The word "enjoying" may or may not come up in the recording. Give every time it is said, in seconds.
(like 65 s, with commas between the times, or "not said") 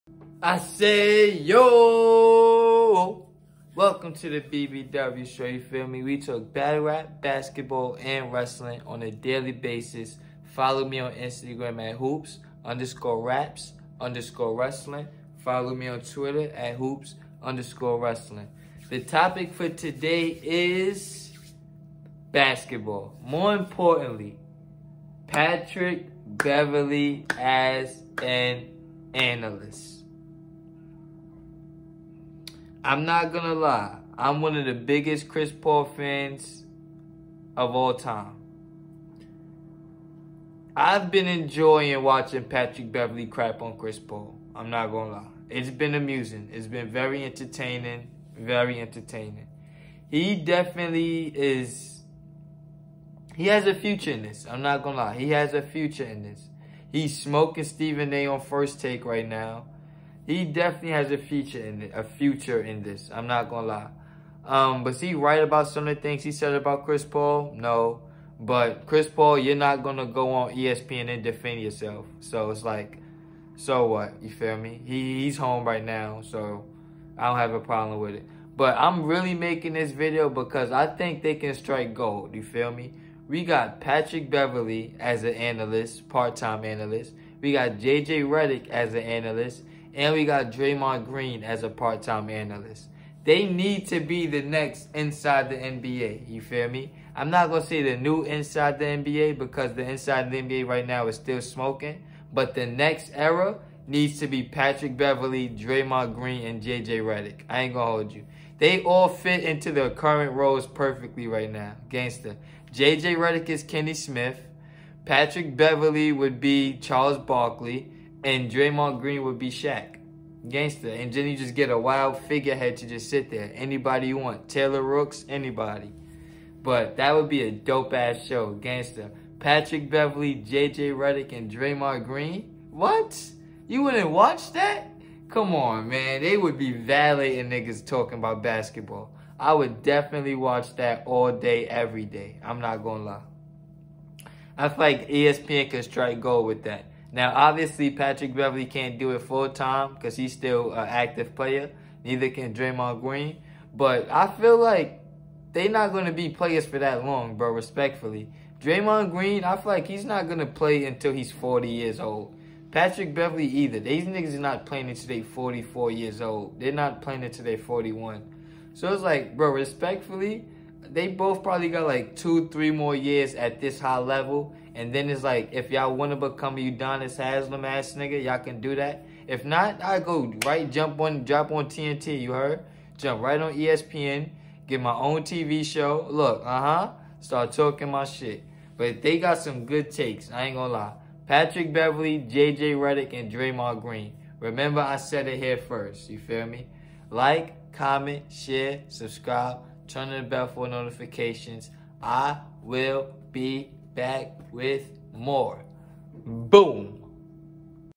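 41 s.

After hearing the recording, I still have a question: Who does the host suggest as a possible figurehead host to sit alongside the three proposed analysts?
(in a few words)
Taylor Rooks.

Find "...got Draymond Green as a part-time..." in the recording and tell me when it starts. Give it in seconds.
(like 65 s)
90 s.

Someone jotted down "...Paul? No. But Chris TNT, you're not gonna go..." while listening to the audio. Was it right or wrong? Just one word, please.
wrong.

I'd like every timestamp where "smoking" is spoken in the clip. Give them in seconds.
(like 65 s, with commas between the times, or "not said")
57 s, 101 s.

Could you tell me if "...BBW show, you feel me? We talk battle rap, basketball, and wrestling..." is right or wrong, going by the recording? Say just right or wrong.
right.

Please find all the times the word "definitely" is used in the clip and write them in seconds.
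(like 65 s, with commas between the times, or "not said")
50 s, 60 s, 139 s.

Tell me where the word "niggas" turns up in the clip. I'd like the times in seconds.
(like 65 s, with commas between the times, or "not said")
137 s, 164 s, 177 s.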